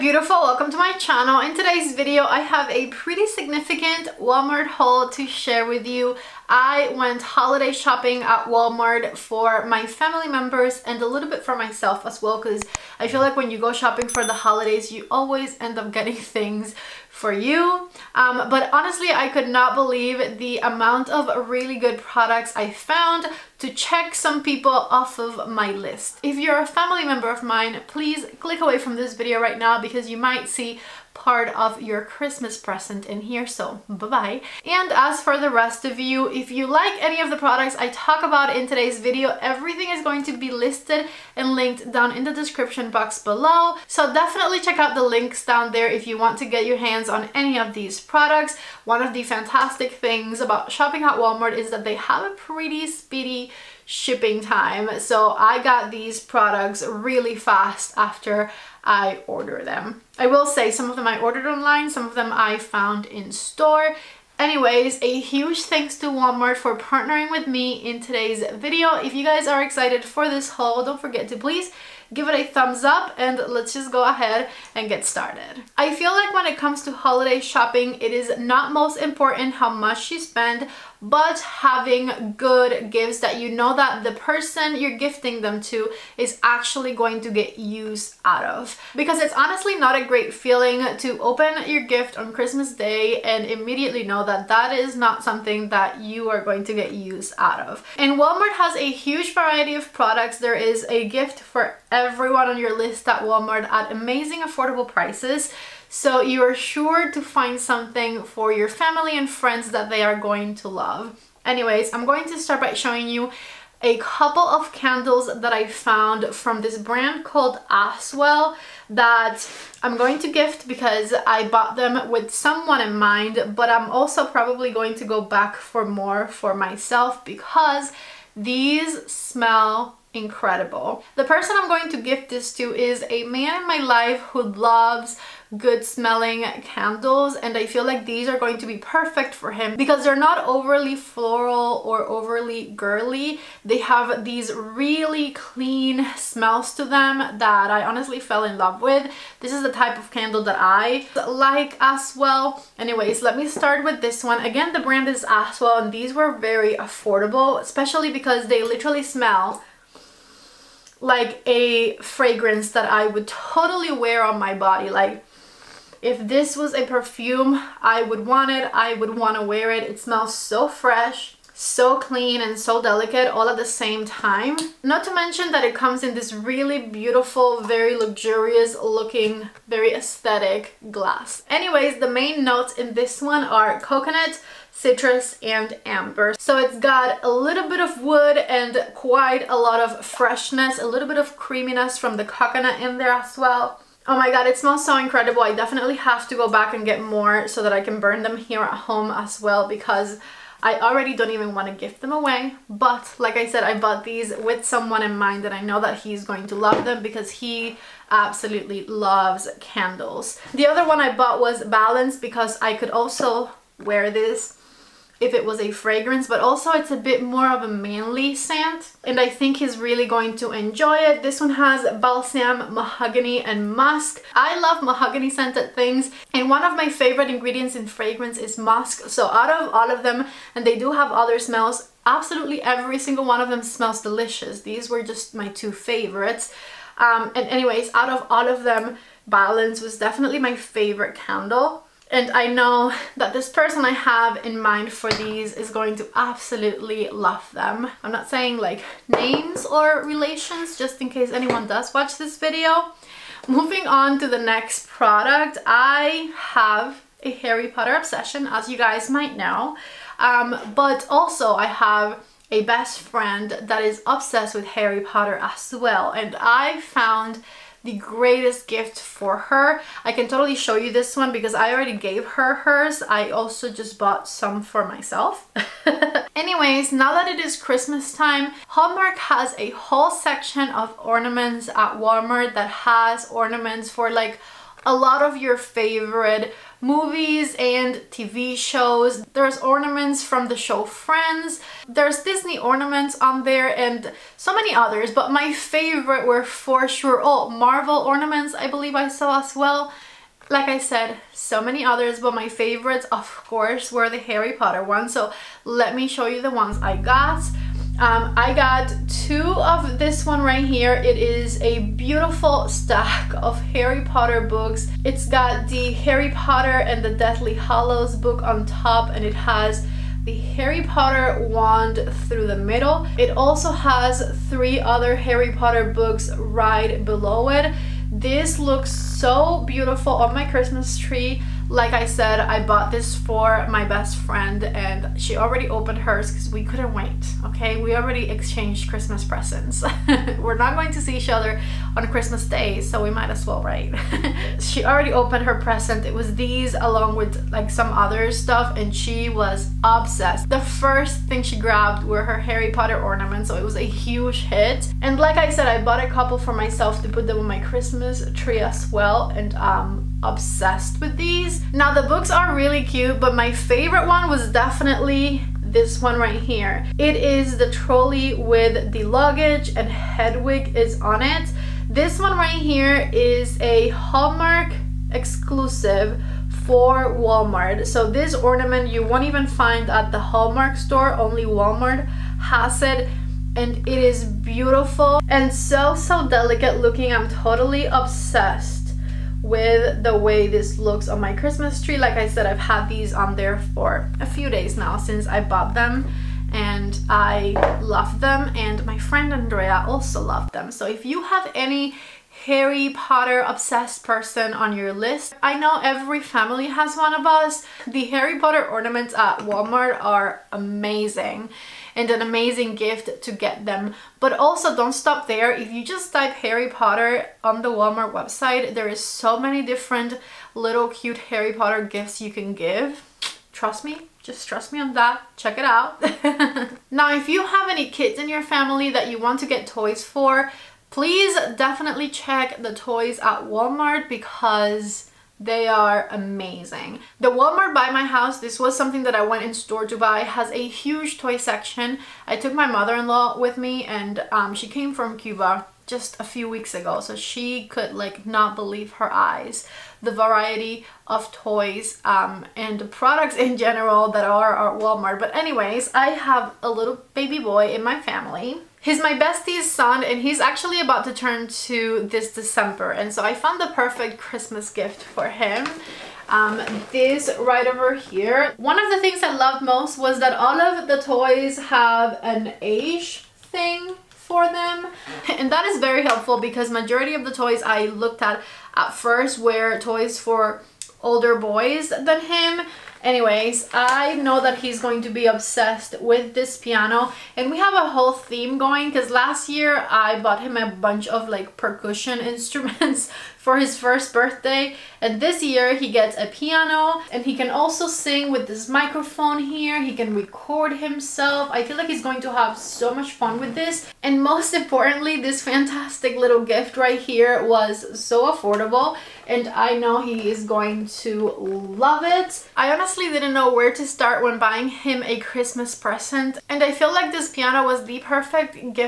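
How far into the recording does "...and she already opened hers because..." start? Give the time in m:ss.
5:34.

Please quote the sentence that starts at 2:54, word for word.
Not to mention that it comes in this really beautiful, very luxurious looking, very aesthetic glass.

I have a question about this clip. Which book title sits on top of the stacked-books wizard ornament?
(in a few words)
Harry Potter and the Deathly Hallows.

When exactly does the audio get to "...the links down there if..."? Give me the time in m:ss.
0:44.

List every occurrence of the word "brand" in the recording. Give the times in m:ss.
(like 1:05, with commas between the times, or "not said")
1:56, 2:34.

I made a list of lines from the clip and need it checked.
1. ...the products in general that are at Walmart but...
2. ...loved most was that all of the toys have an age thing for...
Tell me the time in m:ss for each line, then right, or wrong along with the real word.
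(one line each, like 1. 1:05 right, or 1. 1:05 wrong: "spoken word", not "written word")
1. 7:32 right
2. 7:49 right.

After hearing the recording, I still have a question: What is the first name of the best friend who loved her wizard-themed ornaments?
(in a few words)
Andrea.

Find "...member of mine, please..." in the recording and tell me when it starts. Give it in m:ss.
0:27.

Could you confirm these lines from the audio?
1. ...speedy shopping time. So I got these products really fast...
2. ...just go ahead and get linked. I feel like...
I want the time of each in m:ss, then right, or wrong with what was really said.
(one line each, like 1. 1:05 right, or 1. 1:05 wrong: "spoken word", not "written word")
1. 0:52 wrong: "shipping", not "shopping"
2. 1:13 wrong: "started", not "linked".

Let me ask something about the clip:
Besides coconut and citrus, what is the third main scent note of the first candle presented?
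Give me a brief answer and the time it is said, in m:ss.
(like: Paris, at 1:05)
amber, at 3:05.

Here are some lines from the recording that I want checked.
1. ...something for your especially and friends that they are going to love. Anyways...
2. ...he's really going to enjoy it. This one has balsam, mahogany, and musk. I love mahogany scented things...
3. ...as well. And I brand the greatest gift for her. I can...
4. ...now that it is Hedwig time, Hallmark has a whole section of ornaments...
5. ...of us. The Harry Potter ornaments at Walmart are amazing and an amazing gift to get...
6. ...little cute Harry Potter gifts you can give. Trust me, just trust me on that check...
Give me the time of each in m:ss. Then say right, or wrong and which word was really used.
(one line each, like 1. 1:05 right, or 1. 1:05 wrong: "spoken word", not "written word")
1. 1:47 wrong: "family", not "especially"
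2. 3:39 right
3. 4:25 wrong: "found", not "brand"
4. 4:36 wrong: "Christmas", not "Hedwig"
5. 6:47 right
6. 7:00 right.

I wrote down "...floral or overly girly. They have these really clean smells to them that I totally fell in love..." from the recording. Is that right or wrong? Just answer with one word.
wrong.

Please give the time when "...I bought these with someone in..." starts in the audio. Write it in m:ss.
3:23.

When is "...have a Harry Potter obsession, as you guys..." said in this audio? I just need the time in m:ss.
4:16.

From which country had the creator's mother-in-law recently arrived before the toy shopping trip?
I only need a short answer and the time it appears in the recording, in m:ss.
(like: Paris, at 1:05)
Cuba, at 7:25.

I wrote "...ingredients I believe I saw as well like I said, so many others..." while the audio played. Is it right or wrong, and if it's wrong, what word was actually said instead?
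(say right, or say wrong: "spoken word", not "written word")
wrong: "ornaments", not "ingredients".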